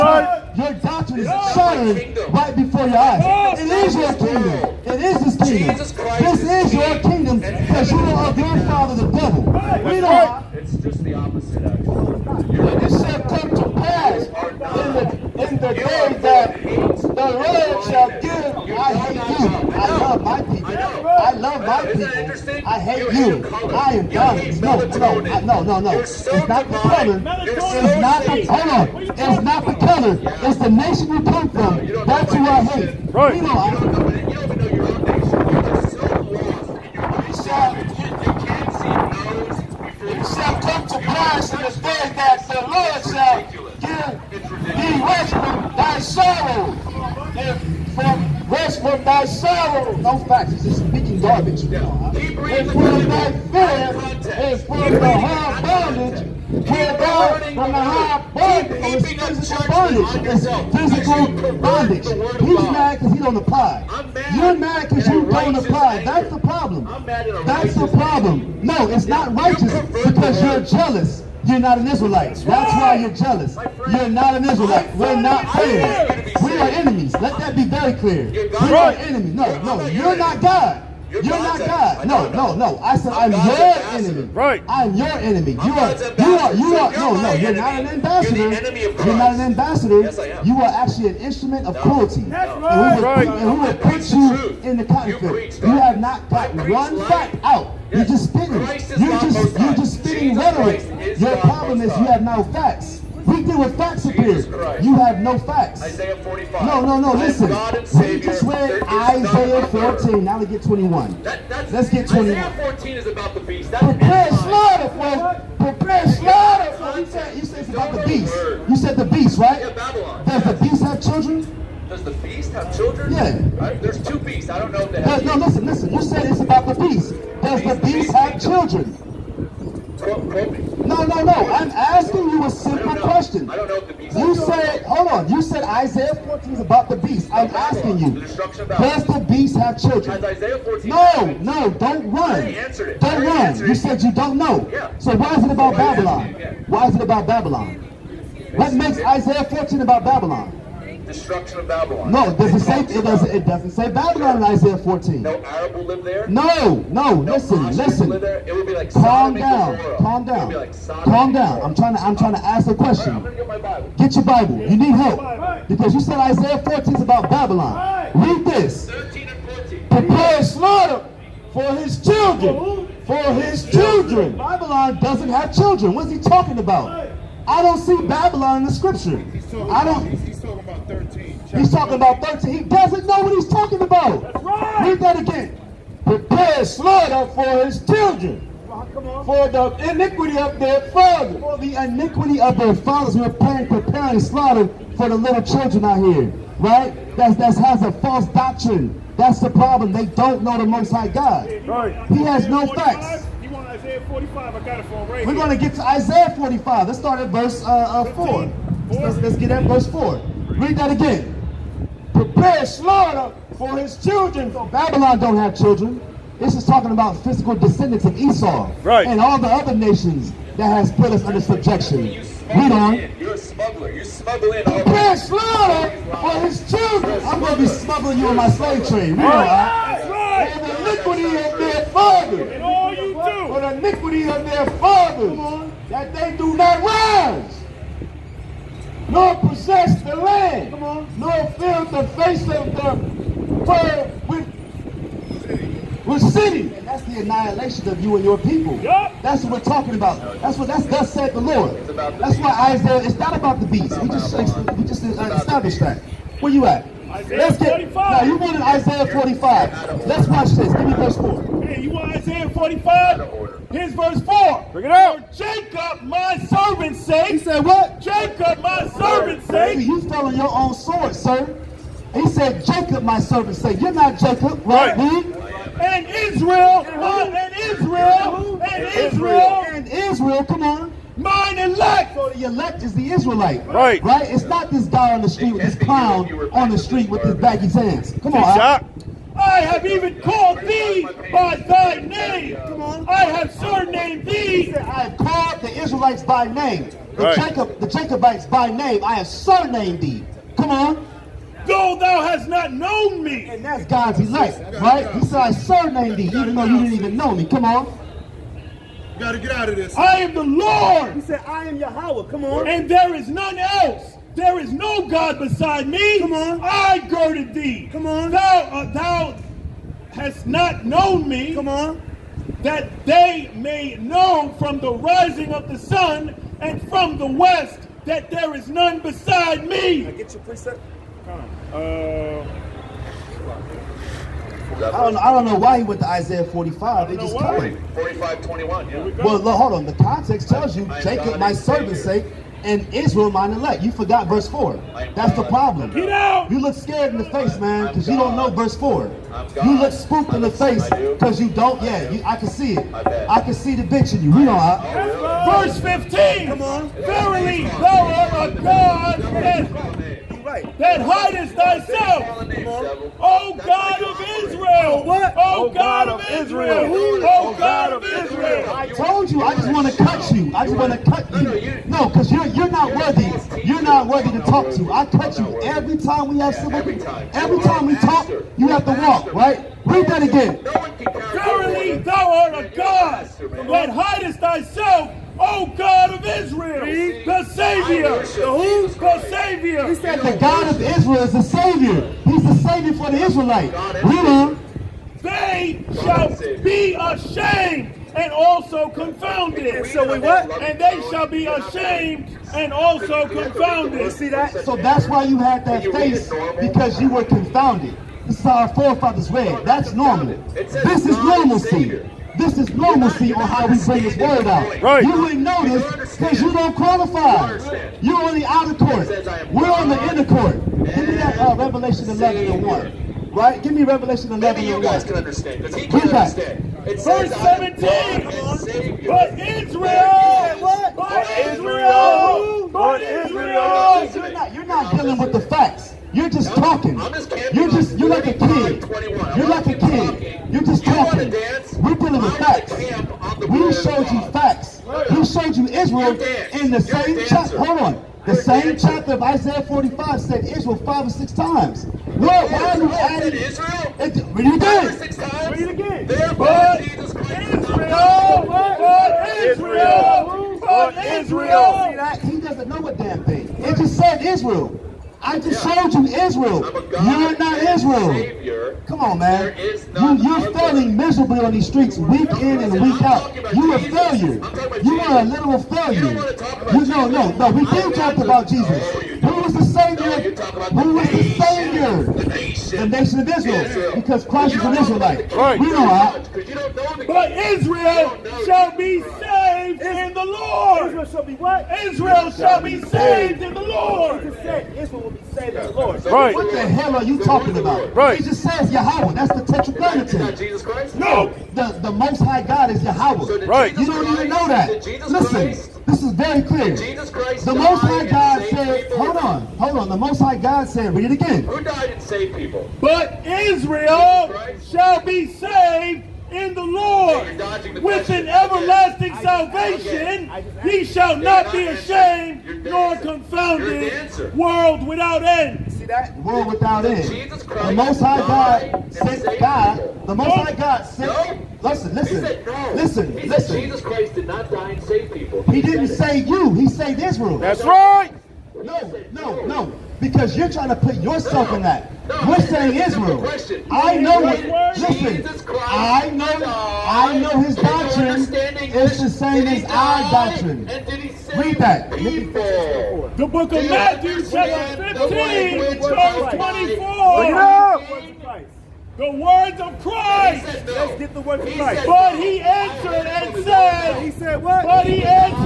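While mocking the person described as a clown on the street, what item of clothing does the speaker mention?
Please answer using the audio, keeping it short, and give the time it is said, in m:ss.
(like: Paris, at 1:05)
Baggy pants, at 4:47.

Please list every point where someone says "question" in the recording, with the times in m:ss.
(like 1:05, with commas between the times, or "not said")
2:12, 2:42.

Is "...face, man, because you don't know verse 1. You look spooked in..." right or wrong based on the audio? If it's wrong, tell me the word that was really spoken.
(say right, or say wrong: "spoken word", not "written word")
wrong: "4", not "1".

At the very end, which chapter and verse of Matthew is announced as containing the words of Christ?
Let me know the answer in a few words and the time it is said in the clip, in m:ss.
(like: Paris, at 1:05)
15:24, at 9:14.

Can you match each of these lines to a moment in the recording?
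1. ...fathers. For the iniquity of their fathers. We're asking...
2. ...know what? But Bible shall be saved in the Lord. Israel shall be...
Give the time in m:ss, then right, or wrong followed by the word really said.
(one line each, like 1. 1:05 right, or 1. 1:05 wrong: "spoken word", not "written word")
1. 3:10 wrong: "preparing", not "asking"
2. 8:05 wrong: "Israel", not "Bible".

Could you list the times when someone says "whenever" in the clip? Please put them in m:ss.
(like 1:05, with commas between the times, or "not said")
not said.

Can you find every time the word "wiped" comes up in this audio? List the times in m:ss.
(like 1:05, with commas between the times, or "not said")
not said.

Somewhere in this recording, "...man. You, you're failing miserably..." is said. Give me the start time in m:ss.
7:49.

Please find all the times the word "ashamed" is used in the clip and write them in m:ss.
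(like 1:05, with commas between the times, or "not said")
6:36, 6:41, 8:41.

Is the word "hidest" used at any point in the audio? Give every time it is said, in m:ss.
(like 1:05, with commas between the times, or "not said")
6:01, 6:23.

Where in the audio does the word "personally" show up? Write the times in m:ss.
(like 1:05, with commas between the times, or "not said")
not said.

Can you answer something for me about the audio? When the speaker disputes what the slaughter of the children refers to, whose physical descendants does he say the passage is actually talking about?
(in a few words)
Esau.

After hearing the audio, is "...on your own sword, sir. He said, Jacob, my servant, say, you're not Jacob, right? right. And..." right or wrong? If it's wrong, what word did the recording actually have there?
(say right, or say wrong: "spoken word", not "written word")
right.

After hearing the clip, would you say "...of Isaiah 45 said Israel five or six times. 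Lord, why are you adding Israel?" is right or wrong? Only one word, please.
right.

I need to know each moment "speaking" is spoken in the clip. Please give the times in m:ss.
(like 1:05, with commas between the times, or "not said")
0:50.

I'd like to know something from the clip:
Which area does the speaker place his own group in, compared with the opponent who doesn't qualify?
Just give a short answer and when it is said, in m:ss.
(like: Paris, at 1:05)
Inner court, at 7:00.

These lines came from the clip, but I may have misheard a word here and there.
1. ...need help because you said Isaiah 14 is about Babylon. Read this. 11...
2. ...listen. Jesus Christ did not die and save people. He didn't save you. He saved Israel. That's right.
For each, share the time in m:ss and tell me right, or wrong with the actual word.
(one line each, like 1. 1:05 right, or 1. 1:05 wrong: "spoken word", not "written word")
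1. 2:44 wrong: "13", not "11"
2. 8:53 right.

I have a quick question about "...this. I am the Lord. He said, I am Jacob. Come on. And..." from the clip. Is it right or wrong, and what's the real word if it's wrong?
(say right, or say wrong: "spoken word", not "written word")
wrong: "Yahweh", not "Jacob".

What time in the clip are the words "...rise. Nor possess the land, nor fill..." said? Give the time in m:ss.
3:56.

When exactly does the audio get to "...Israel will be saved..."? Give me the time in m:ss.
8:14.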